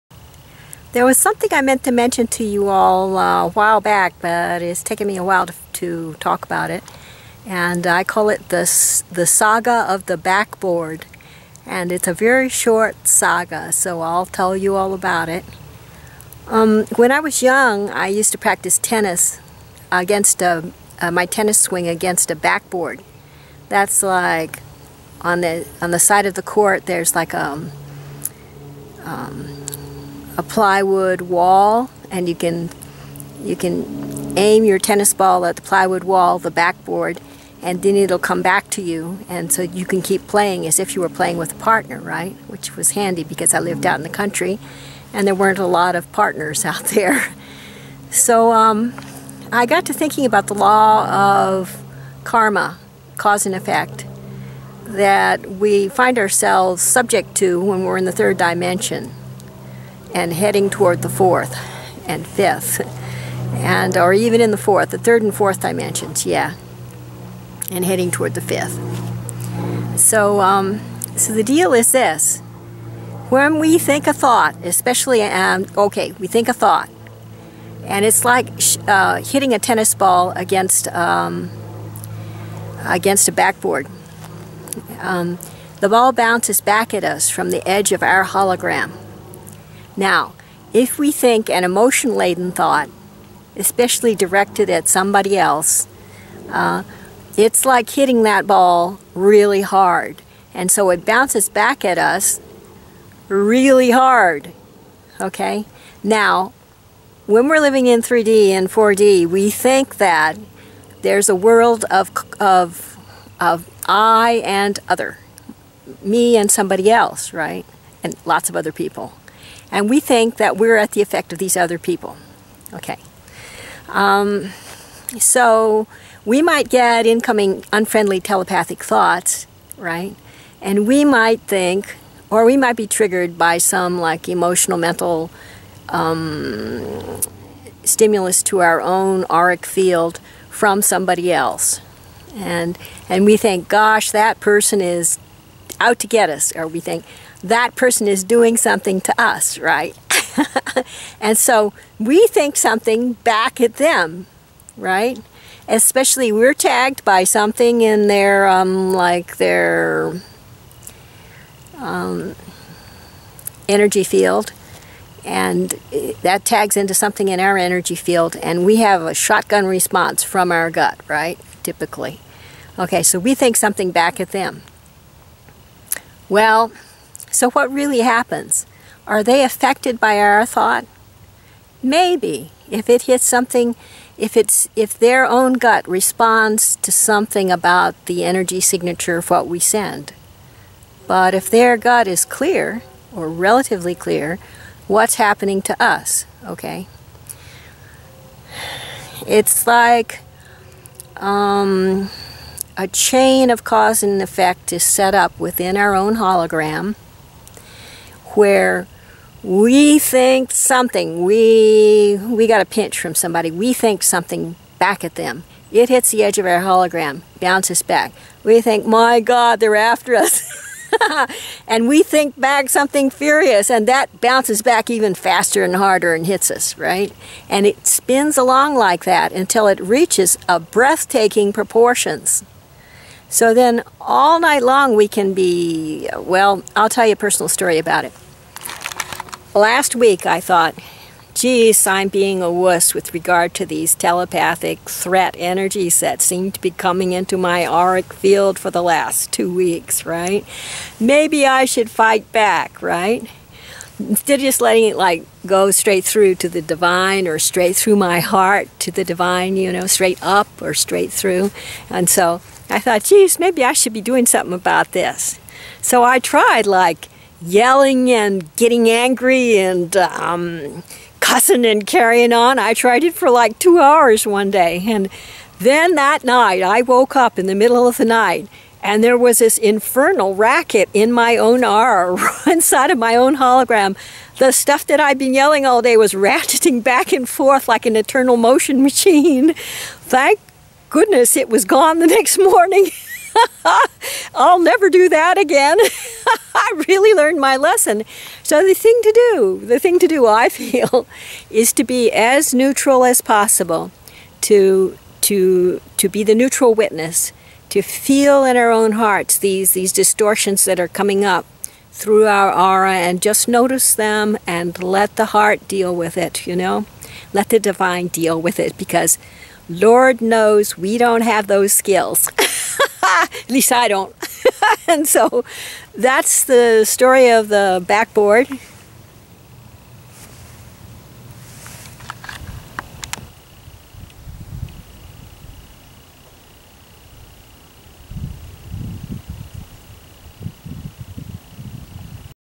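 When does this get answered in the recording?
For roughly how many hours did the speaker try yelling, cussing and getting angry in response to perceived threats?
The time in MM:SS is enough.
04:33.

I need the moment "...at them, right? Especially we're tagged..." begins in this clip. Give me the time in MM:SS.
02:33.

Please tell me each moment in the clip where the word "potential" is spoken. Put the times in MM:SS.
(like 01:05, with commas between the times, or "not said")
not said.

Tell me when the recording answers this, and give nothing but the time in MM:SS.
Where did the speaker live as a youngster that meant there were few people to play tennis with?
00:43.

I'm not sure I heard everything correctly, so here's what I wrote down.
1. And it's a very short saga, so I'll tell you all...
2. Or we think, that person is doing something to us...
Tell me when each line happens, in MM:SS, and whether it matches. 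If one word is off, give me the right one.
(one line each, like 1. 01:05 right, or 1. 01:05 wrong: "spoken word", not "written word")
1. 00:11 right
2. 02:26 right.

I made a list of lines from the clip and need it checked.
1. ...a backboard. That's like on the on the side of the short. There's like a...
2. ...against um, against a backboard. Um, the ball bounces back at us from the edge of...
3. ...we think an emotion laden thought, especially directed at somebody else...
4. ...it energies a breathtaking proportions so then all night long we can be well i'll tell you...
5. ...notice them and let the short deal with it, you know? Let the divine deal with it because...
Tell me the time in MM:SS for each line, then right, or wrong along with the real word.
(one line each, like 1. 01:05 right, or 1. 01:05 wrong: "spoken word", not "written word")
1. 00:22 wrong: "court", not "short"
2. 01:20 right
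3. 01:30 right
4. 03:49 wrong: "reaches", not "energies"
5. 05:13 wrong: "heart", not "short".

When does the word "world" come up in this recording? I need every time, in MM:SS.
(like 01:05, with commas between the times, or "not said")
01:51.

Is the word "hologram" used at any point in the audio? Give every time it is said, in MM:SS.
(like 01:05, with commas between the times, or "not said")
01:28, 03:26, 03:36, 04:43.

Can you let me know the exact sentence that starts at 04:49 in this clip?
Thank goodness it was gone the next morning.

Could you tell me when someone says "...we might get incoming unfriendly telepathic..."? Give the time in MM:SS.
02:06.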